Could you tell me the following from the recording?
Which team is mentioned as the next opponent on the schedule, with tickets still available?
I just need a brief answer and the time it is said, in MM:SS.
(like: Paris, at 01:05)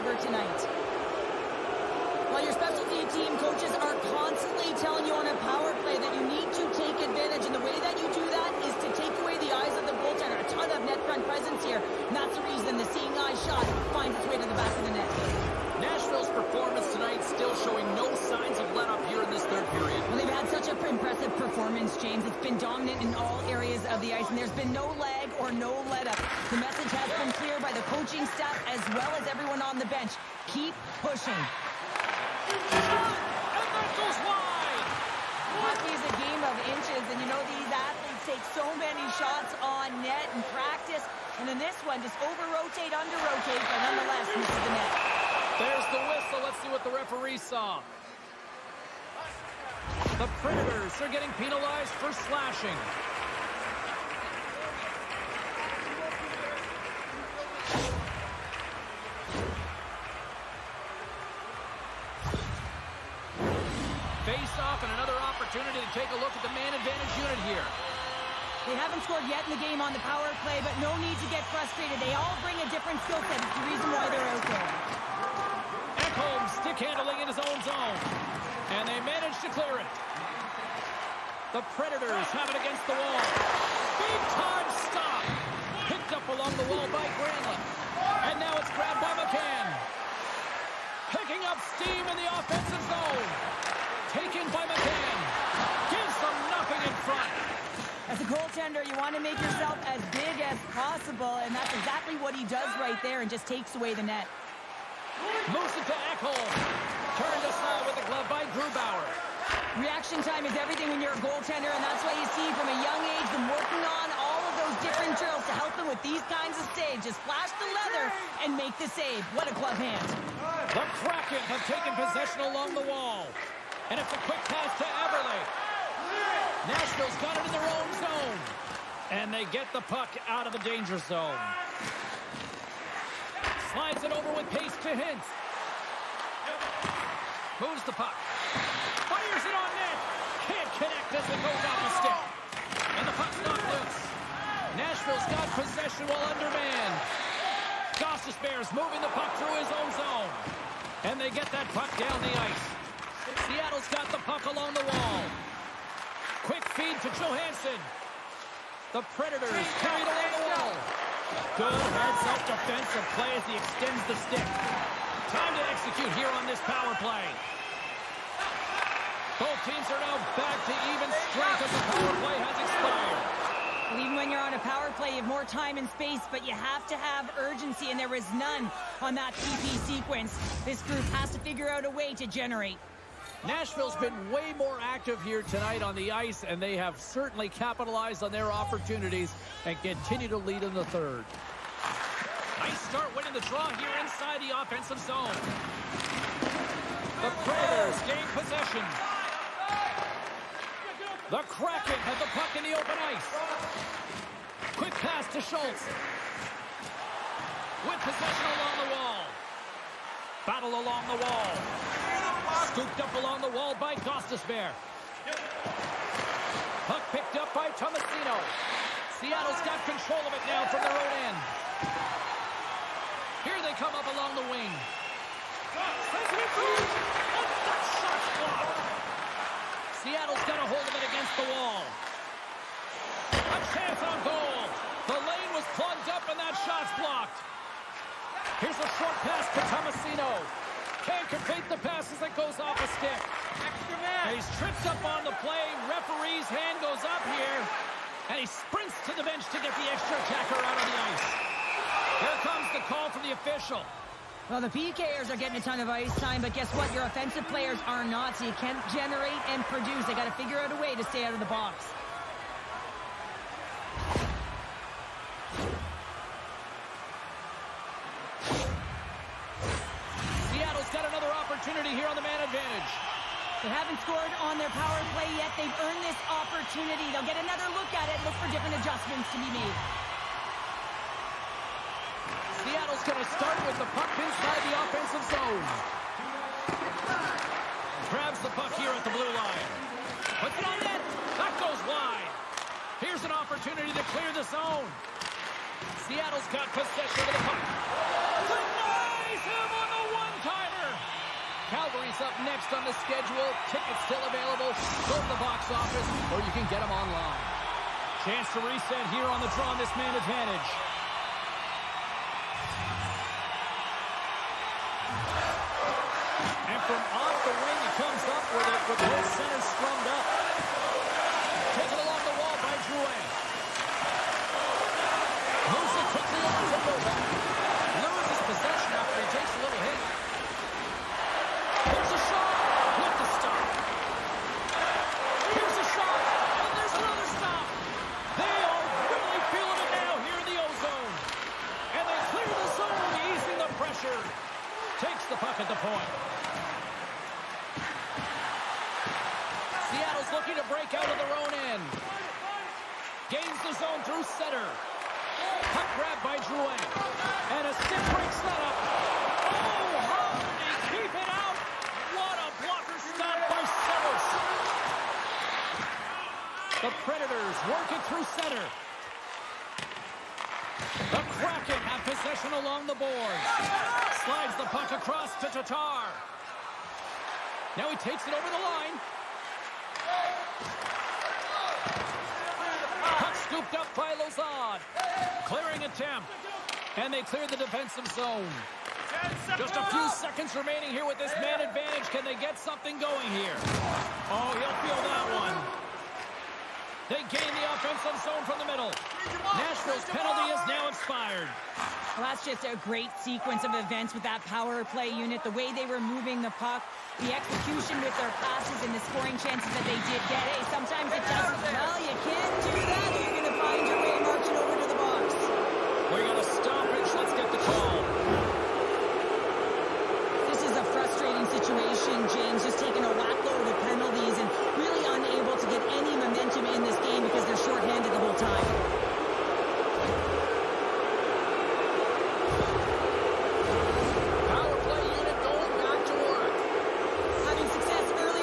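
Calgary, at 05:01.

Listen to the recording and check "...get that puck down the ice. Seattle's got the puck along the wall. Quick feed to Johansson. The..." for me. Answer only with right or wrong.
right.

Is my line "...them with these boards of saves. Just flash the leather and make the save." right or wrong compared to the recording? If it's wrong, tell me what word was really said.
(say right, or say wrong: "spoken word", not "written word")
wrong: "kinds", not "boards".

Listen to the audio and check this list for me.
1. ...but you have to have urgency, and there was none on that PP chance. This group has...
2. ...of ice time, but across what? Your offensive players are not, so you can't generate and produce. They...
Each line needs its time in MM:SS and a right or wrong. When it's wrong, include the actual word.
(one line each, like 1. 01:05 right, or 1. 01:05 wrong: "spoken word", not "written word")
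1. 02:56 wrong: "sequence", not "chance"
2. 04:15 wrong: "guess", not "across".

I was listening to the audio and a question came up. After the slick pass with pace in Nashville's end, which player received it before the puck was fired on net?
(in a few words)
Hintz.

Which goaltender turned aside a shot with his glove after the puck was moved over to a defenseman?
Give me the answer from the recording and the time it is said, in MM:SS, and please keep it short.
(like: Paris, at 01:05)
Grubauer, at 01:48.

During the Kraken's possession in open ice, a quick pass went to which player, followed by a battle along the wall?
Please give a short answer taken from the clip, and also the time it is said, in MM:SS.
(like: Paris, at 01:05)
Schultz, at 03:25.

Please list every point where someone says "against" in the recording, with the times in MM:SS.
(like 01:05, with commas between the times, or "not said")
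01:22, 03:51.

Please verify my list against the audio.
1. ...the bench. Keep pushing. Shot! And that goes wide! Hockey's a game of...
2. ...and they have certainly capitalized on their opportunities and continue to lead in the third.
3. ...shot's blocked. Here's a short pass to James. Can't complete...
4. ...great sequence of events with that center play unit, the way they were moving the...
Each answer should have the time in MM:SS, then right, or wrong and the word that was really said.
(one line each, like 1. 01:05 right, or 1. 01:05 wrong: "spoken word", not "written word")
1. 00:29 right
2. 03:06 right
3. 03:56 wrong: "Tomasino", not "James"
4. 06:42 wrong: "power", not "center".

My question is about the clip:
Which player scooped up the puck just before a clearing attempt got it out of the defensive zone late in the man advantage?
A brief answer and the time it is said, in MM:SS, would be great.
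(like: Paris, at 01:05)
Lauzon, at 06:24.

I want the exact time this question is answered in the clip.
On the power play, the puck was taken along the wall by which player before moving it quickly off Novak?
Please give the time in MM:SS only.
05:22.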